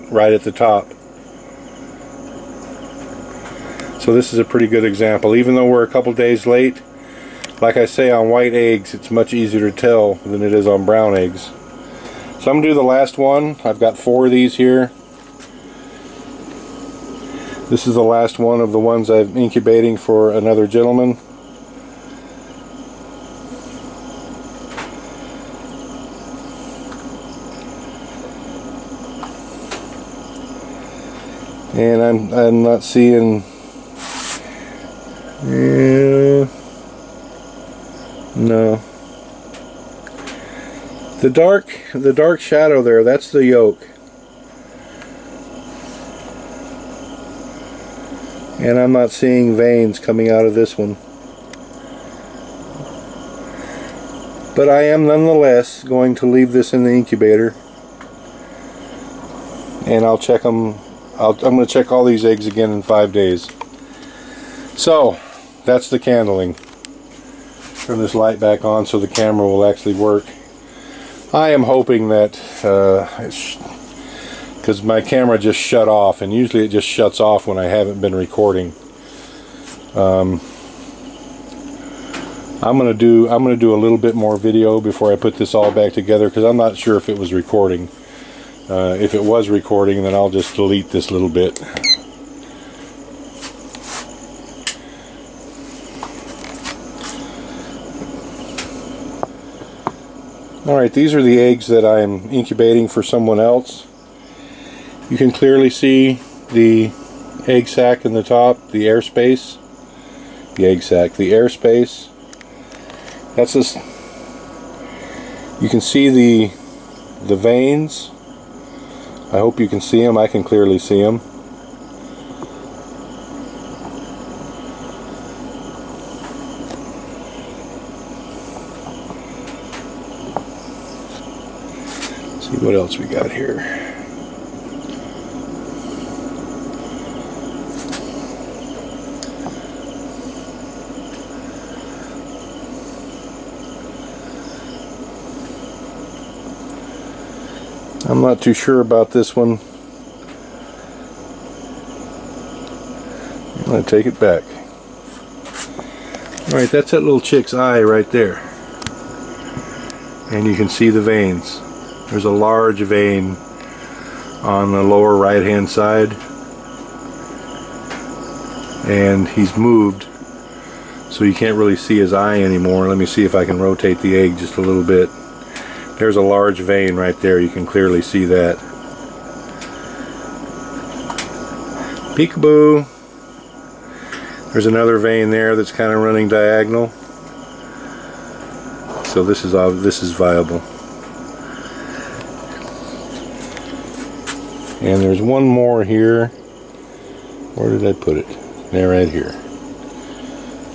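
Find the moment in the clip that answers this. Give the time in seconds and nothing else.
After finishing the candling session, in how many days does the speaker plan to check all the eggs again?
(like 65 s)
62 s.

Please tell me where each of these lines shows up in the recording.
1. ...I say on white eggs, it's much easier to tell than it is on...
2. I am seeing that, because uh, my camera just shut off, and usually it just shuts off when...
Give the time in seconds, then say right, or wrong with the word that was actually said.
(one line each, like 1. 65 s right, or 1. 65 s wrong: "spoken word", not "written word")
1. 7 s right
2. 71 s wrong: "hoping", not "seeing".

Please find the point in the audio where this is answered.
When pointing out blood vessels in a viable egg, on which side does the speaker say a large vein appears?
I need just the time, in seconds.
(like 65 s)
164 s.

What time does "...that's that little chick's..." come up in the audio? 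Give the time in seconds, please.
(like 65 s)
156 s.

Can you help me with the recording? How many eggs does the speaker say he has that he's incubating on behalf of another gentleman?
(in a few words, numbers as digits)
4.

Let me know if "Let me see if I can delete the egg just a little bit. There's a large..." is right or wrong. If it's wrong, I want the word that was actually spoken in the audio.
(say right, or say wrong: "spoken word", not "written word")
wrong: "rotate", not "delete".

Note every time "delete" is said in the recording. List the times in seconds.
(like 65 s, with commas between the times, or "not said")
90 s.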